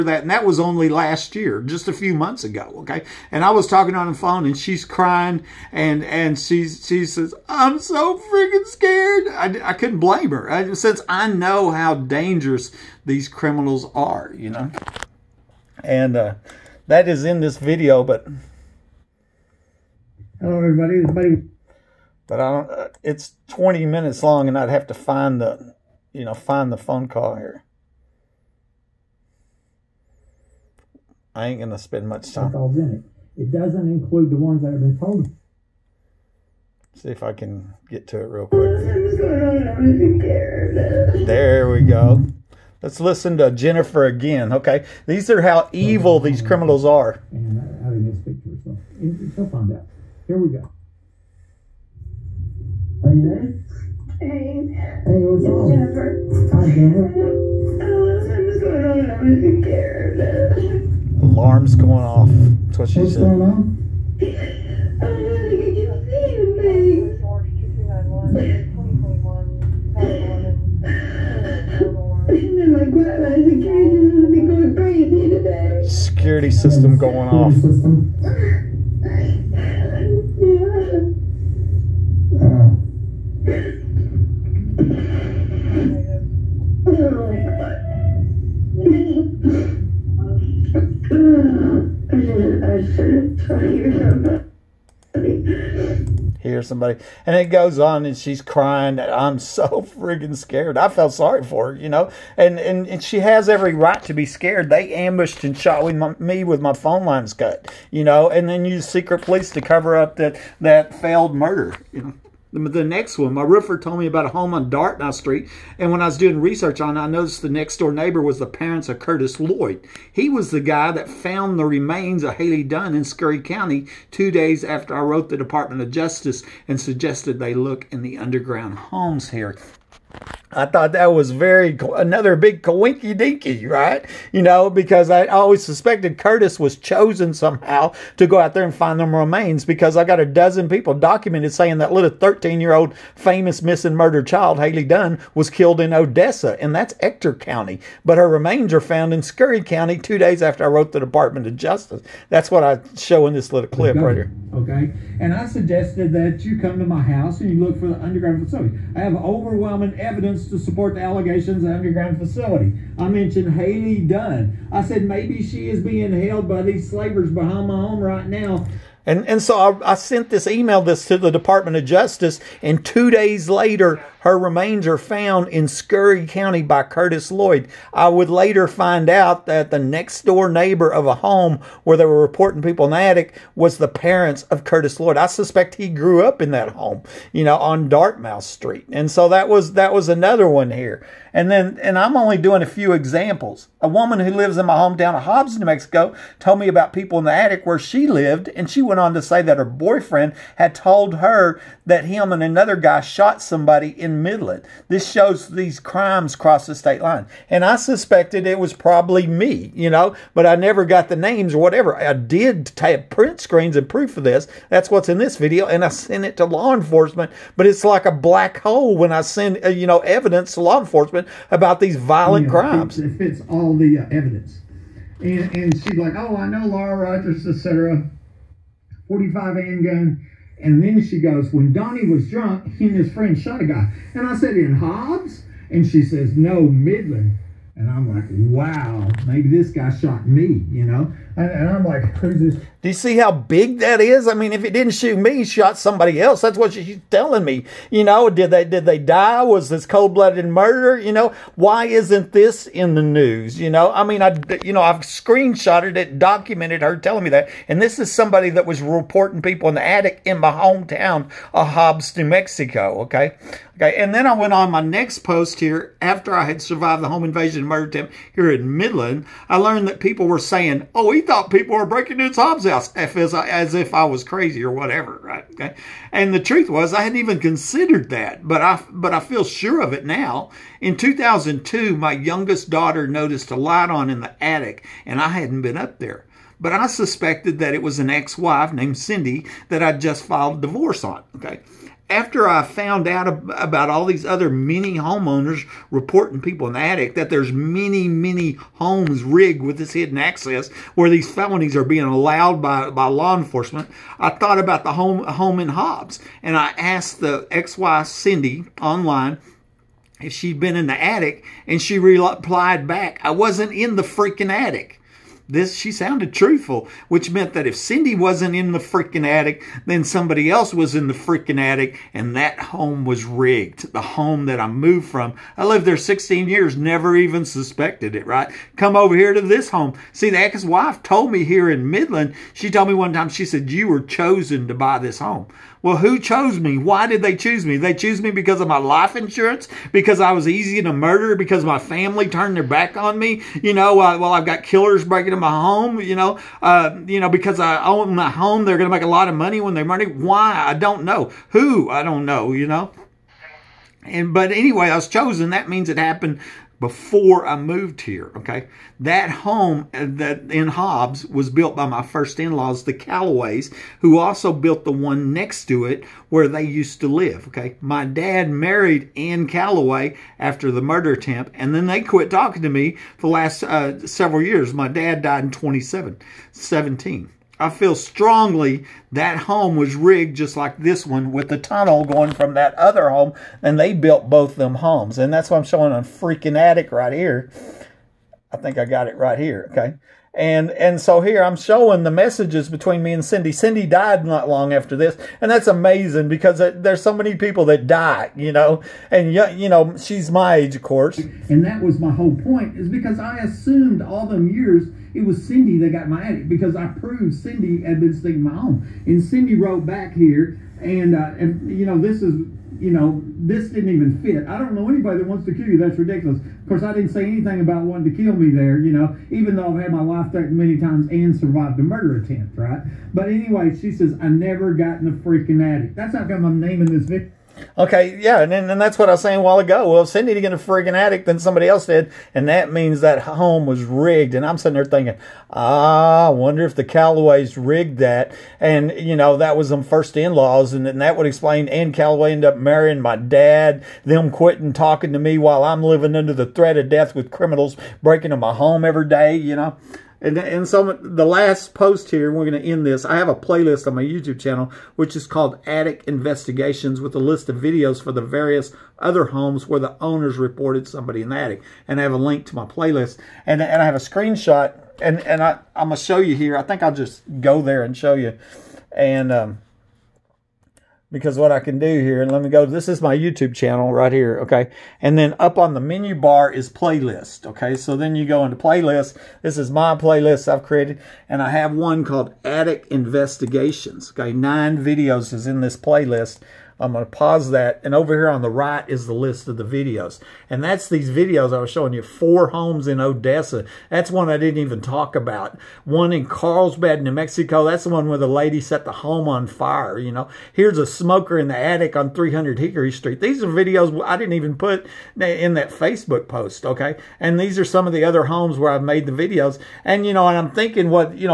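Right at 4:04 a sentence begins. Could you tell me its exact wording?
I mean, if it didn't shoot me, shot somebody else.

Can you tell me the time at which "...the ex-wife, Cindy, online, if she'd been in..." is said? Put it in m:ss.
5:07.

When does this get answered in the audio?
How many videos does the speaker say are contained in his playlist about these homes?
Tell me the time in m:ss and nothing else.
8:04.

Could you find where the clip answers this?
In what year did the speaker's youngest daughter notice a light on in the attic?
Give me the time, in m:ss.
4:40.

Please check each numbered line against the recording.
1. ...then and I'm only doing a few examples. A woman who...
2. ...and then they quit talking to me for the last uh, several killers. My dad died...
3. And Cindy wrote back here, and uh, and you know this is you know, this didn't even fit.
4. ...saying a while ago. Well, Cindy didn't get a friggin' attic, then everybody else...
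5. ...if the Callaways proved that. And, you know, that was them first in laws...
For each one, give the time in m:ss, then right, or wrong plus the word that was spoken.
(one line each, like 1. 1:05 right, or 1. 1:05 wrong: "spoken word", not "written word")
1. 3:11 right
2. 6:11 wrong: "years", not "killers"
3. 6:49 right
4. 7:09 wrong: "somebody", not "everybody"
5. 7:16 wrong: "rigged", not "proved".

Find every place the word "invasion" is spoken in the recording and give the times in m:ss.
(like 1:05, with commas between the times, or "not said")
4:27.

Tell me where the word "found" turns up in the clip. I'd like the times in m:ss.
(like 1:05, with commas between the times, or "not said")
2:01, 2:28, 2:54, 4:52.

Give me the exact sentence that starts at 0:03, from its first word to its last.
And I was talking on the phone, and she's crying, and and she's, she says, I'm so freaking scared.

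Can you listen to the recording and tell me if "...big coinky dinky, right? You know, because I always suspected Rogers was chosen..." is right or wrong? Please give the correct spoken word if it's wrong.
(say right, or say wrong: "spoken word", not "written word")
wrong: "Curtis", not "Rogers".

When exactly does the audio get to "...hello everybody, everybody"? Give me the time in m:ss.
0:20.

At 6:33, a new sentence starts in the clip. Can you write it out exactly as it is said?
Cindy died not long after this, and that's amazing because there's so many people that die, you know.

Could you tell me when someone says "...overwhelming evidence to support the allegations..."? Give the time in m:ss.
2:39.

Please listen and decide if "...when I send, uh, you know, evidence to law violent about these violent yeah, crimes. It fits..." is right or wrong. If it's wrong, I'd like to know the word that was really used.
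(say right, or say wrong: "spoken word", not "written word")
wrong: "enforcement", not "violent".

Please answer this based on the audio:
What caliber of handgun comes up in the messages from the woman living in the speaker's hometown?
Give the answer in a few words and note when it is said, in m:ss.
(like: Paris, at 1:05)
45, at 3:49.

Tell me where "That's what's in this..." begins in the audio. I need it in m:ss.
3:34.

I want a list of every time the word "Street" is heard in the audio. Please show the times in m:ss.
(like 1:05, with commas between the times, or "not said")
1:55, 3:08, 8:22.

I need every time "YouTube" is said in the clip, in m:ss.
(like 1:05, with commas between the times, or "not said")
7:34, 7:53.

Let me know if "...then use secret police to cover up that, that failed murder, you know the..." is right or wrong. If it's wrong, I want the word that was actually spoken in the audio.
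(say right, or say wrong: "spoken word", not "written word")
right.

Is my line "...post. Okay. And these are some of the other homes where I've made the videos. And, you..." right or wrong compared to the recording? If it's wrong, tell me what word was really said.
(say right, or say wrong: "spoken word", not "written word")
right.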